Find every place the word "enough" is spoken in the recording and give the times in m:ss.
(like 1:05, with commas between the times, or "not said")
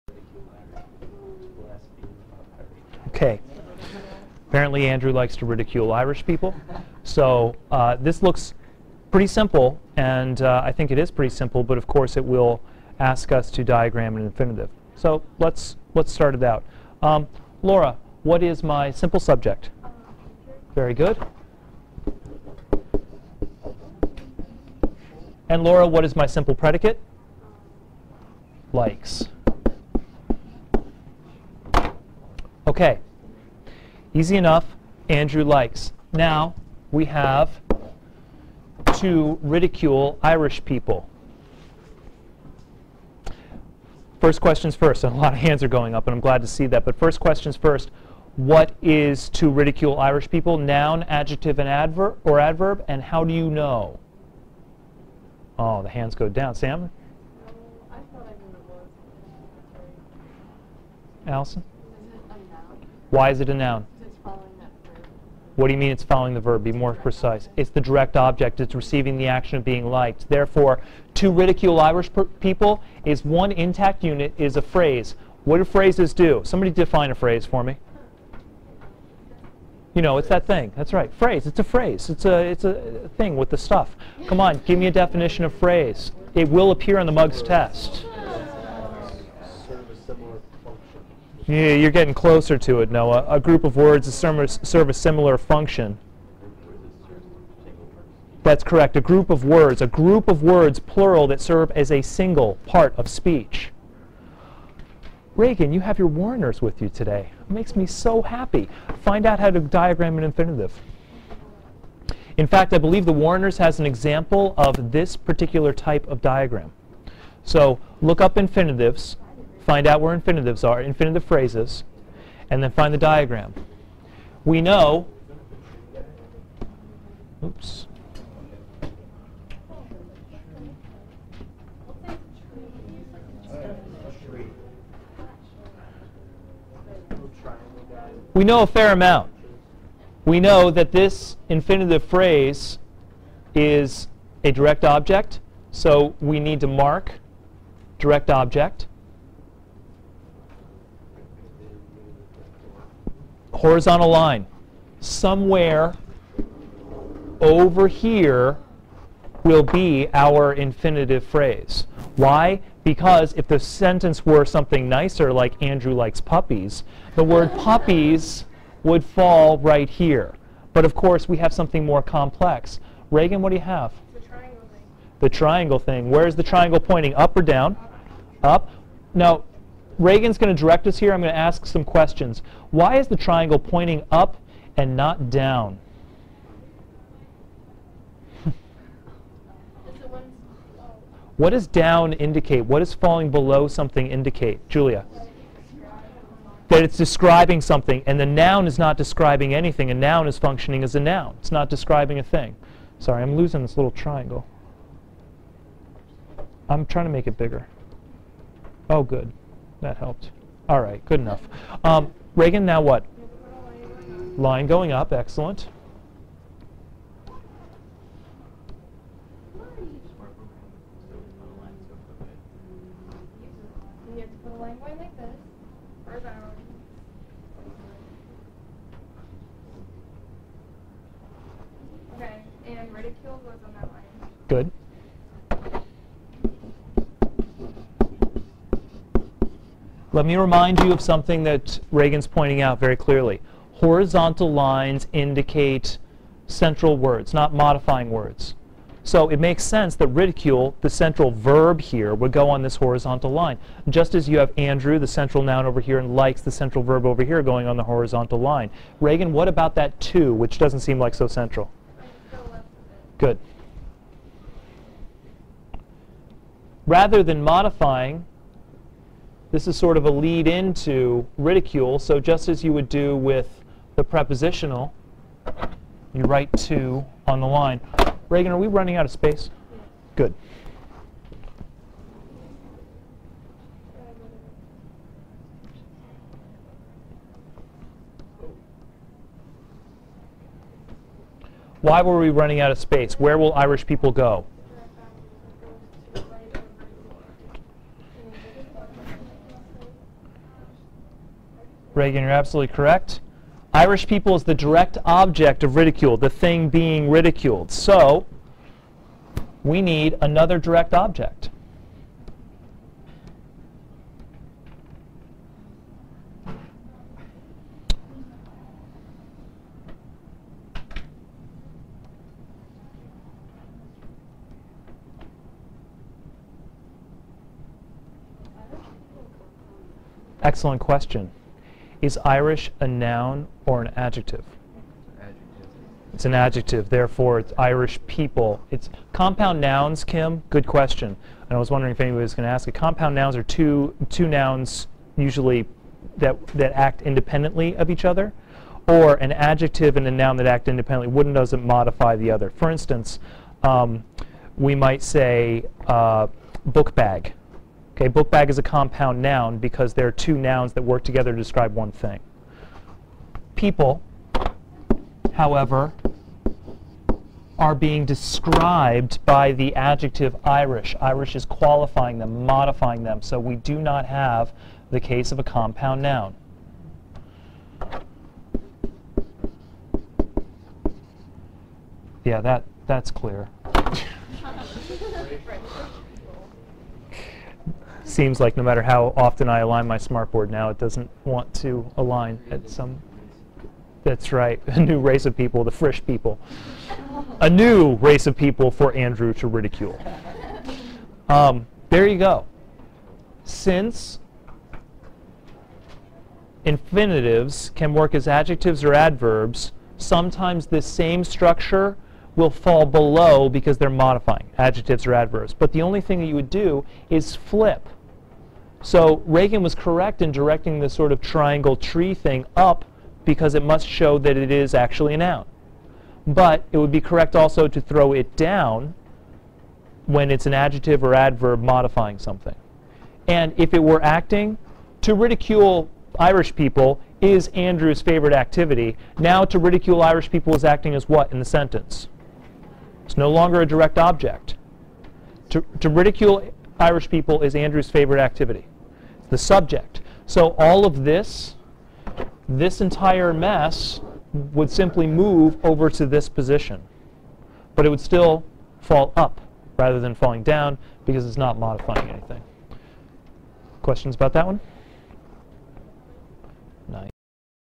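0:34.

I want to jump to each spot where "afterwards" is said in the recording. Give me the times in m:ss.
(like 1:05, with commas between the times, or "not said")
not said.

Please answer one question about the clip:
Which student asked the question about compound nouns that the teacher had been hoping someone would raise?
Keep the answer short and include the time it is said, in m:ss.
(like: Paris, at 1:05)
Kim, at 5:40.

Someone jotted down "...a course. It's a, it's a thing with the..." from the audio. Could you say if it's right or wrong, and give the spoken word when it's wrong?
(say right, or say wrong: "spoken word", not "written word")
wrong: "phrase", not "course".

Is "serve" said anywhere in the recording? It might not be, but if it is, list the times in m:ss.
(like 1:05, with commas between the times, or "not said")
1:34, 1:41.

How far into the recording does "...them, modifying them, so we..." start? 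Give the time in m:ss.
6:12.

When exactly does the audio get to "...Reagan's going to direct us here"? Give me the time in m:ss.
3:00.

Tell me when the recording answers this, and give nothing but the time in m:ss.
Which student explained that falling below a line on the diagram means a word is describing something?
3:14.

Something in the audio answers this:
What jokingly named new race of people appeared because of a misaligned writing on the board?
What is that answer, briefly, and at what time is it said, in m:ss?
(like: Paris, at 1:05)
Frisch people, at 6:35.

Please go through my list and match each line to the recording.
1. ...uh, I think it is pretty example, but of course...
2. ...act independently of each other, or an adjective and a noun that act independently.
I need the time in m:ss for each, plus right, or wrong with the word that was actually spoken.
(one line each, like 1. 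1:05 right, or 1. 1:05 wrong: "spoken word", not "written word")
1. 0:10 wrong: "simple", not "example"
2. 5:46 right.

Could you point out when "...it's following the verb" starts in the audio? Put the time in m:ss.
1:05.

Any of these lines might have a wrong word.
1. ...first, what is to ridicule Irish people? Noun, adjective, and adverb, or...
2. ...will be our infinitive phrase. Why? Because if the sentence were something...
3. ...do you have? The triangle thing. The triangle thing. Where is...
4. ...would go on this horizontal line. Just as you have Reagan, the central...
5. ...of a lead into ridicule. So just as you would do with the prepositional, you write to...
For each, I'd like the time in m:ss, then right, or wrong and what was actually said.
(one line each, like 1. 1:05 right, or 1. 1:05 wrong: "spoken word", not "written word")
1. 0:47 right
2. 2:39 right
3. 2:53 right
4. 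4:12 wrong: "Andrew", not "Reagan"
5. 4:29 right.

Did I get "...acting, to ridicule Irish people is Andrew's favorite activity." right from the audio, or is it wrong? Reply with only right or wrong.
right.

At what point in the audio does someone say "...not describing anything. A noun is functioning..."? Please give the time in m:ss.
3:18.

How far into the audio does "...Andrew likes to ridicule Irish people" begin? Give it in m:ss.
0:04.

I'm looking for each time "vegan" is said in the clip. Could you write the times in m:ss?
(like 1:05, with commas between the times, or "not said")
not said.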